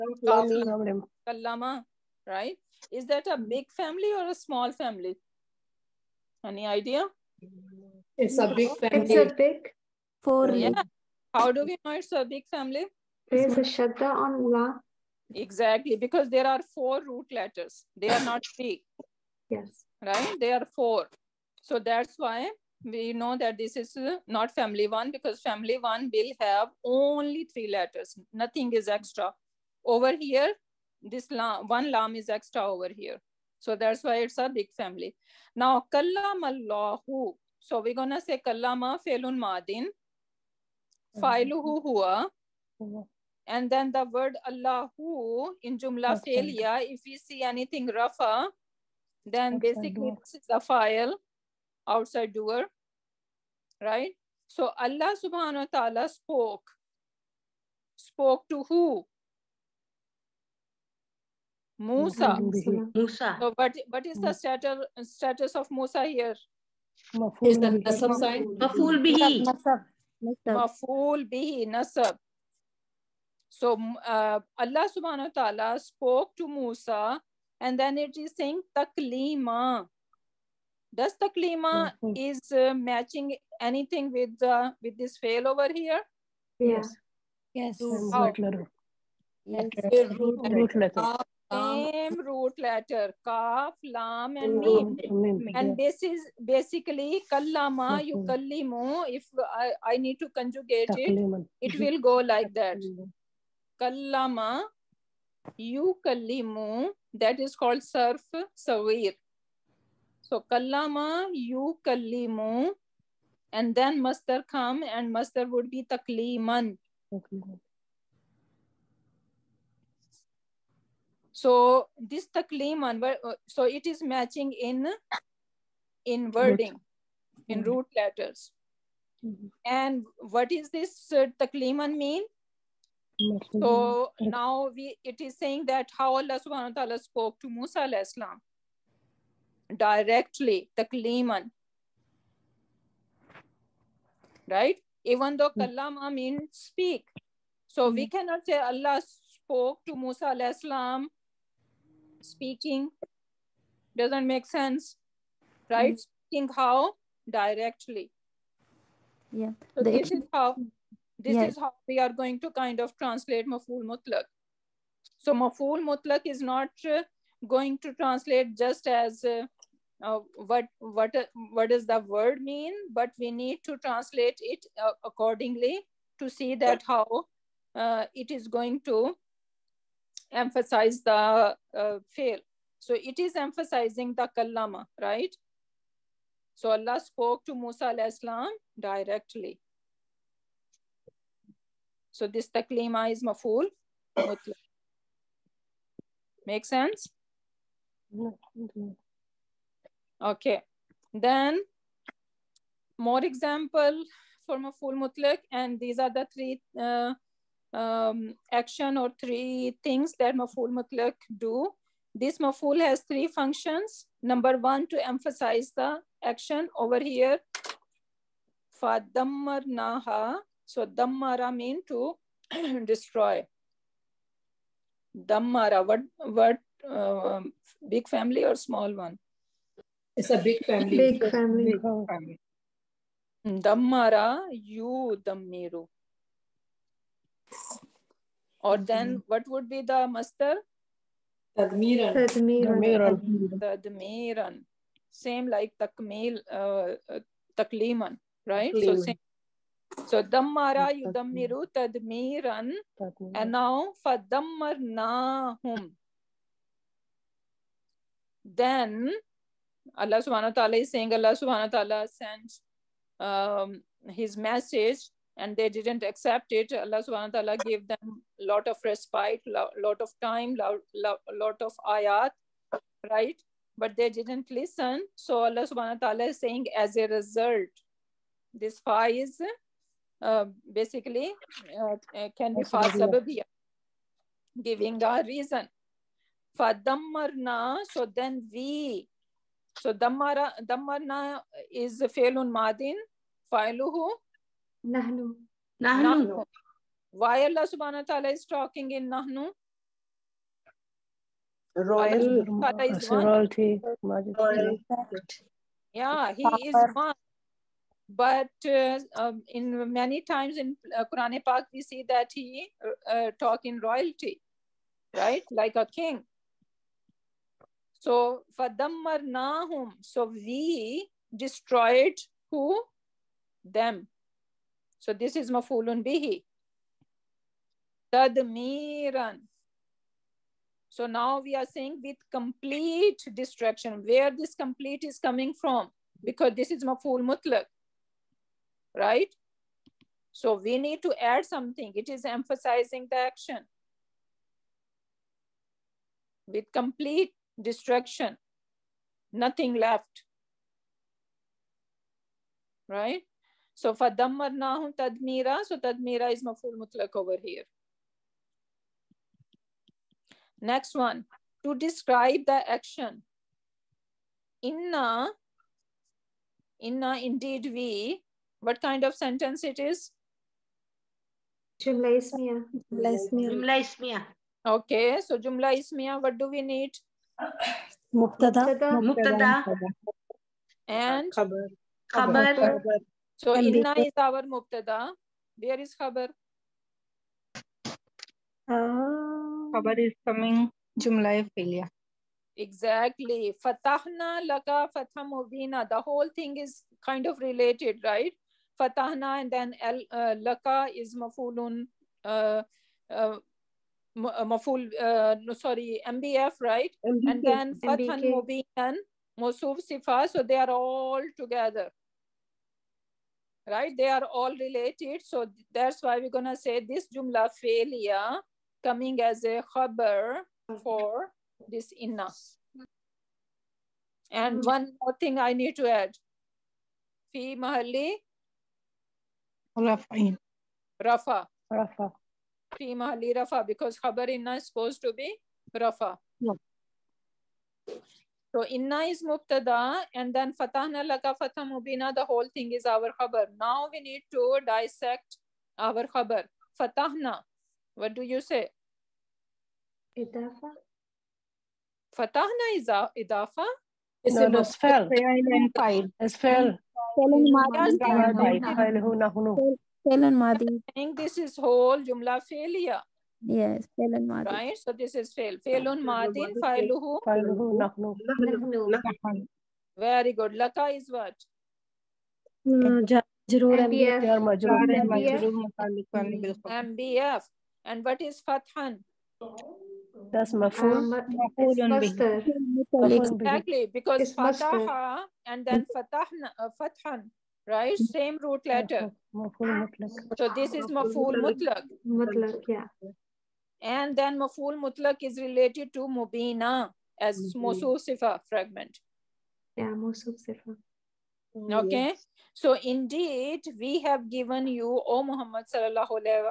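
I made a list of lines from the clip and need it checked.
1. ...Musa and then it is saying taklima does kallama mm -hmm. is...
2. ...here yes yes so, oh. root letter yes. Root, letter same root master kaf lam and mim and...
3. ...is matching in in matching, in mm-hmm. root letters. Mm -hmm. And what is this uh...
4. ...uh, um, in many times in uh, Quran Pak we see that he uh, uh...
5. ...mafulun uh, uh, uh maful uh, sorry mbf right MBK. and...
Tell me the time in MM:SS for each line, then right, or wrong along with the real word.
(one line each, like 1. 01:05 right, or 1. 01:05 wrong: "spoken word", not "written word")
1. 01:16 wrong: "taklima", not "kallama"
2. 01:25 wrong: "letter", not "master"
3. 02:03 wrong: "wording", not "matching"
4. 05:08 right
5. 06:41 right.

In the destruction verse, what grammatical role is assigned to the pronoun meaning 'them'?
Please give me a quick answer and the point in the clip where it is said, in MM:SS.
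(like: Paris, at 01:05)
mafulun bihi, at 05:25.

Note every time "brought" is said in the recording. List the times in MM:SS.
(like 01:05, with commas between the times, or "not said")
not said.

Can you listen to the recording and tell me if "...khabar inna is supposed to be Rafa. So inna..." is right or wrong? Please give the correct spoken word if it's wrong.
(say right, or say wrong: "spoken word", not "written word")
right.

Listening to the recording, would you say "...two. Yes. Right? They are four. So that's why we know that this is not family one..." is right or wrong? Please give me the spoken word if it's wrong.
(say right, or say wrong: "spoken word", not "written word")
wrong: "three", not "two".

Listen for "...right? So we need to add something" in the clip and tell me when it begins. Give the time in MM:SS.
05:38.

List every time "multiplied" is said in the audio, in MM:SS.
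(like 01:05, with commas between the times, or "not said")
not said.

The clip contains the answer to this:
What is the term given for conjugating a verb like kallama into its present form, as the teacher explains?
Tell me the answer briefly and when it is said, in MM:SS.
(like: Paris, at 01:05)
surf sawir, at 01:47.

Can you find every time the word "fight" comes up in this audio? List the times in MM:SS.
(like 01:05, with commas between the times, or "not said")
07:35.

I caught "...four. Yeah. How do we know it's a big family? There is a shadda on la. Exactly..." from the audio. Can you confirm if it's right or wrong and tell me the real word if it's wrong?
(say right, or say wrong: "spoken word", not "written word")
right.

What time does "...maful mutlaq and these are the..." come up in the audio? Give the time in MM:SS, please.
03:24.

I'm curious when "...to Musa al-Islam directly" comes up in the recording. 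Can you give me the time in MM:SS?
03:07.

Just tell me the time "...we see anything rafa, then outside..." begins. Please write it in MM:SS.
00:47.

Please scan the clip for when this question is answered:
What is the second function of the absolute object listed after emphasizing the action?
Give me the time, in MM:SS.
06:01.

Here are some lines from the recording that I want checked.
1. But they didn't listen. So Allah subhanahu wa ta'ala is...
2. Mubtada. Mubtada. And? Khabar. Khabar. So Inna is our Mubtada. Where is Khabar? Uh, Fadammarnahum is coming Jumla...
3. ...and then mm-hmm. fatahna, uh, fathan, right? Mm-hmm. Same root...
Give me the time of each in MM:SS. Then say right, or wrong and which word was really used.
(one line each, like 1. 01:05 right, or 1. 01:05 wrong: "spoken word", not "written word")
1. 04:33 right
2. 06:18 wrong: "Khabar", not "Fadammarnahum"
3. 08:05 right.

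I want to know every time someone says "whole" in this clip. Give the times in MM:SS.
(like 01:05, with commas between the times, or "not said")
06:36, 07:22, 07:41.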